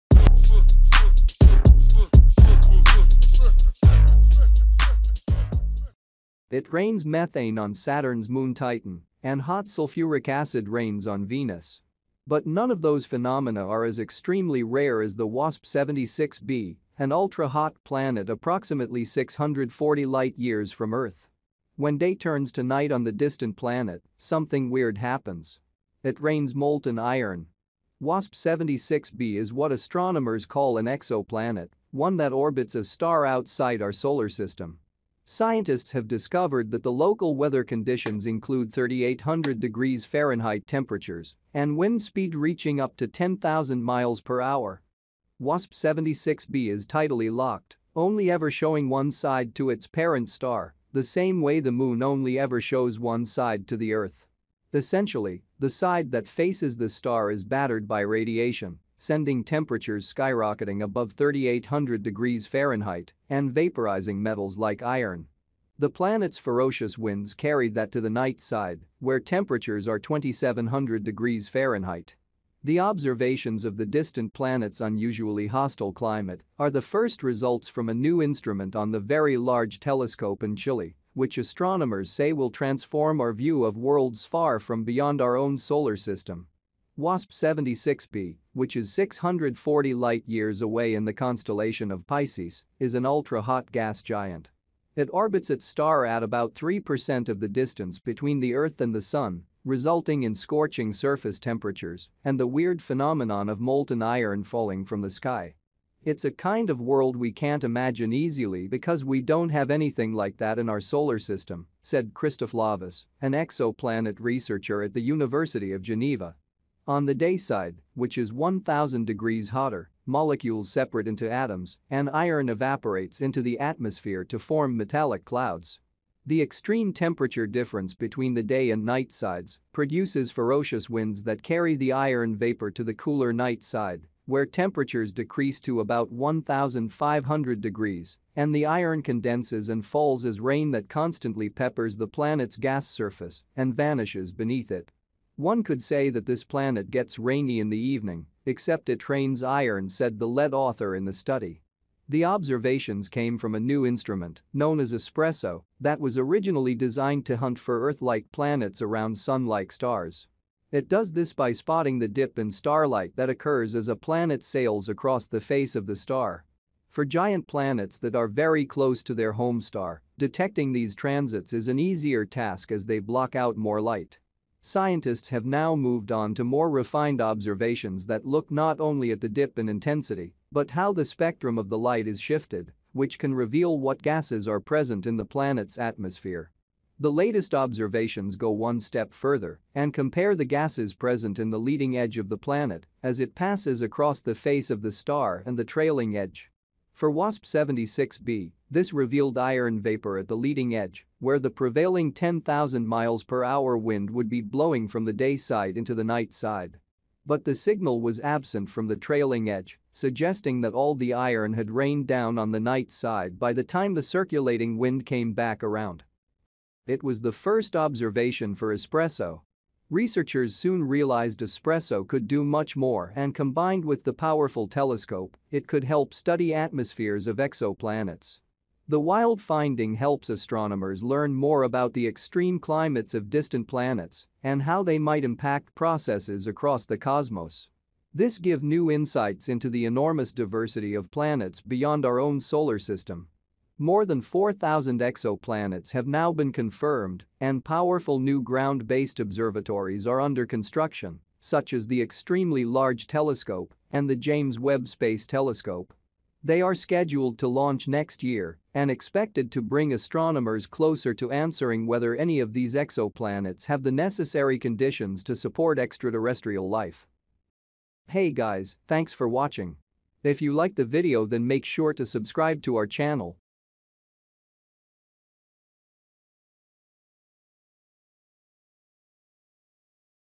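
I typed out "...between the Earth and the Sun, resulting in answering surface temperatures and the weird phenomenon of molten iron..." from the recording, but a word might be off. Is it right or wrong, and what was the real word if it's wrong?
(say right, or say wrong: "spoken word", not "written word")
wrong: "scorching", not "answering".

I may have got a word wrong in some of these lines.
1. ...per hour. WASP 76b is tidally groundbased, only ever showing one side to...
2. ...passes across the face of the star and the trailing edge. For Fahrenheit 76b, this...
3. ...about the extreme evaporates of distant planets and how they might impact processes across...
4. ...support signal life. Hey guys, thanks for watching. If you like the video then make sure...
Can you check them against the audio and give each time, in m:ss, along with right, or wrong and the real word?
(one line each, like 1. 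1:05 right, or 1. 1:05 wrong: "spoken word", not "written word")
1. 0:44 wrong: "locked", not "groundbased"
2. 3:13 wrong: "WASP", not "Fahrenheit"
3. 3:51 wrong: "climates", not "evaporates"
4. 4:25 wrong: "extraterrestrial", not "signal".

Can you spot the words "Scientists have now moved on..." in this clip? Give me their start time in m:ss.
2:54.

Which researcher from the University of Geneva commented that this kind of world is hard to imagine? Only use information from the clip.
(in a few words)
Christoph Lovis.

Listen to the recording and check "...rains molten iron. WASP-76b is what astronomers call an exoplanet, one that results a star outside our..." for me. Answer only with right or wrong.
wrong.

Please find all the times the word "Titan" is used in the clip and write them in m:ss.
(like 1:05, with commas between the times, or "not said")
0:08.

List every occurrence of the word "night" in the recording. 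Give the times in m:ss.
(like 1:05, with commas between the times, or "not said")
0:22, 1:08, 2:08, 2:13, 3:26, 3:32.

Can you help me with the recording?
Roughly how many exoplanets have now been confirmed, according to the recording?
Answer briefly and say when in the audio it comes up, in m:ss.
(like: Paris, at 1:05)
More than 4,000, at 4:03.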